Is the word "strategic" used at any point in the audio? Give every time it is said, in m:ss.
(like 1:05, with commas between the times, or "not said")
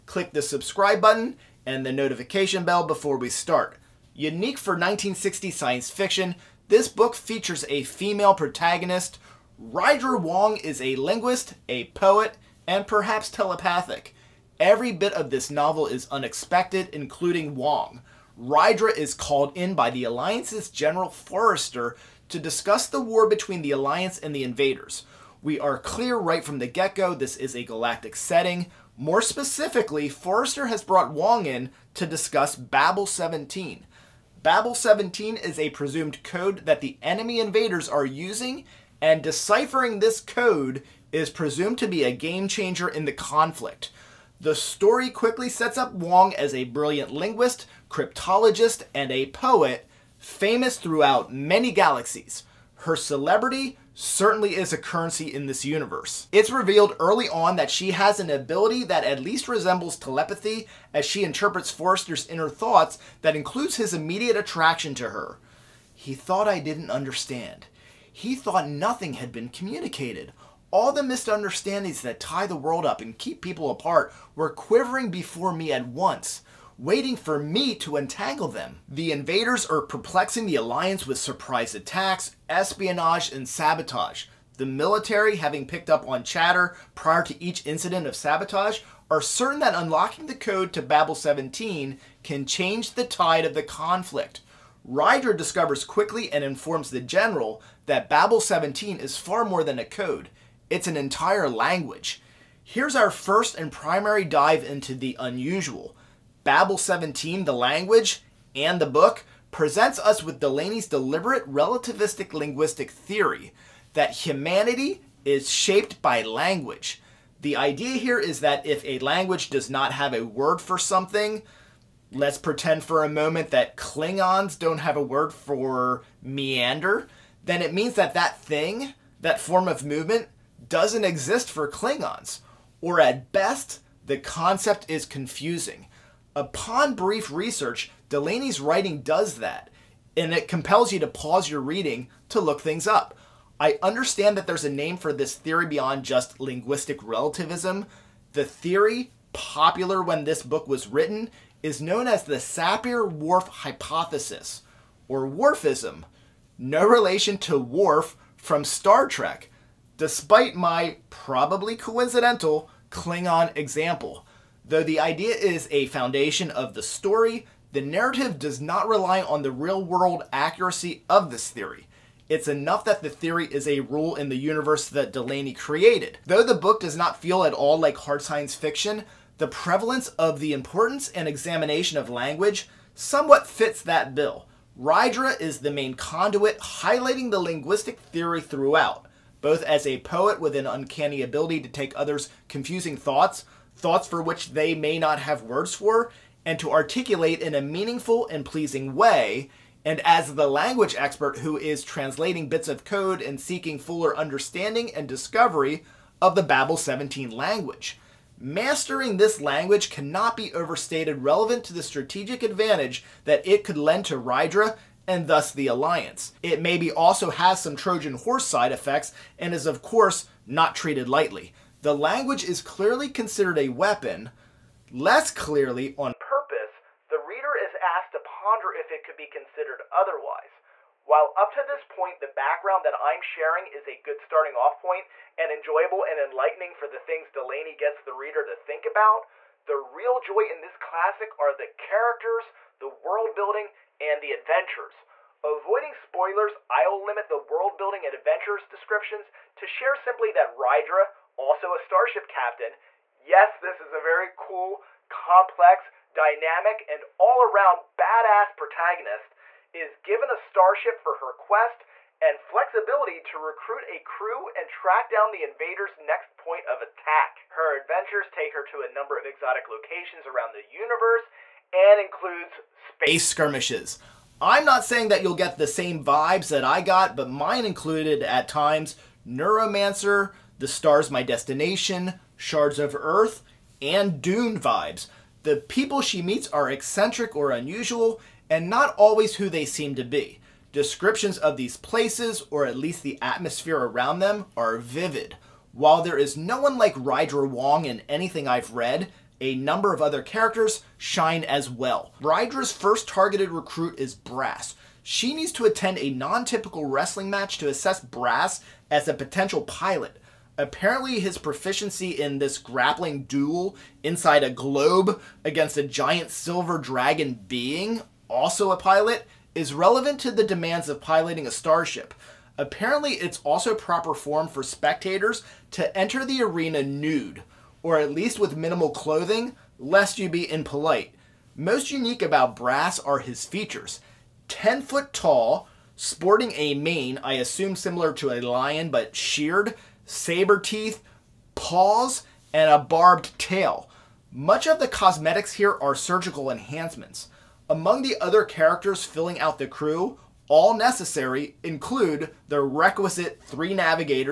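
3:31.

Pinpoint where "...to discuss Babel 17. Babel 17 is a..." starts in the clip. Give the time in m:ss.
0:31.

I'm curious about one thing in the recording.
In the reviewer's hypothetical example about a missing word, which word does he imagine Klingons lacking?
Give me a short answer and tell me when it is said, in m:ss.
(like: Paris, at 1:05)
meander, at 2:06.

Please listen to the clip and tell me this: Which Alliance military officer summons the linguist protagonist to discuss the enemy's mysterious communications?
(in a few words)
General Forrester.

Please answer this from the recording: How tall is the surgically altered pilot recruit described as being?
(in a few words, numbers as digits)
10 feet.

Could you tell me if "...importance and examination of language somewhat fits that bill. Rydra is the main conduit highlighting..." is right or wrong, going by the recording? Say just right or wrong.
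right.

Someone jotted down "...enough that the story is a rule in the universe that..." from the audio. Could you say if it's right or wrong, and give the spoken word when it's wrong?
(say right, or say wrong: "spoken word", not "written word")
wrong: "theory", not "story".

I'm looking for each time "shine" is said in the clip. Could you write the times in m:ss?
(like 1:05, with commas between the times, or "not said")
5:00.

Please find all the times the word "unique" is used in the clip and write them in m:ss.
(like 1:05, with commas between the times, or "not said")
0:04, 5:31.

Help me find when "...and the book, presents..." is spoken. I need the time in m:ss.
1:48.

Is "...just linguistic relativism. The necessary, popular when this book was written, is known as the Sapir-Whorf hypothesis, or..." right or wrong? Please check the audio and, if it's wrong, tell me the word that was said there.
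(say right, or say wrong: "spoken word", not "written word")
wrong: "theory", not "necessary".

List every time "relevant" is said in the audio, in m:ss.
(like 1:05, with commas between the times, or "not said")
3:31, 5:19.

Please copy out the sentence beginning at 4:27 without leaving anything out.
Her adventures take her to a number of exotic locations around the universe and includes space skirmishes.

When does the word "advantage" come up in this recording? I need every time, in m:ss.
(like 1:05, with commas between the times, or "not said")
3:32.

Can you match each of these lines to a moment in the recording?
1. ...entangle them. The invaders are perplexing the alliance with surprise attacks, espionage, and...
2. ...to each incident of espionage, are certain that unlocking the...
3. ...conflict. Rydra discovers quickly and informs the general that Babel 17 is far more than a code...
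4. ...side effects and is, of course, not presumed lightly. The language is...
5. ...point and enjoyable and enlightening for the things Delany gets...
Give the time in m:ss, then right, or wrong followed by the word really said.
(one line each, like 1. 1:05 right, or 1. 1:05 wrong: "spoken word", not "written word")
1. 1:17 right
2. 1:27 wrong: "sabotage", not "espionage"
3. 1:33 right
4. 3:38 wrong: "treated", not "presumed"
5. 3:54 right.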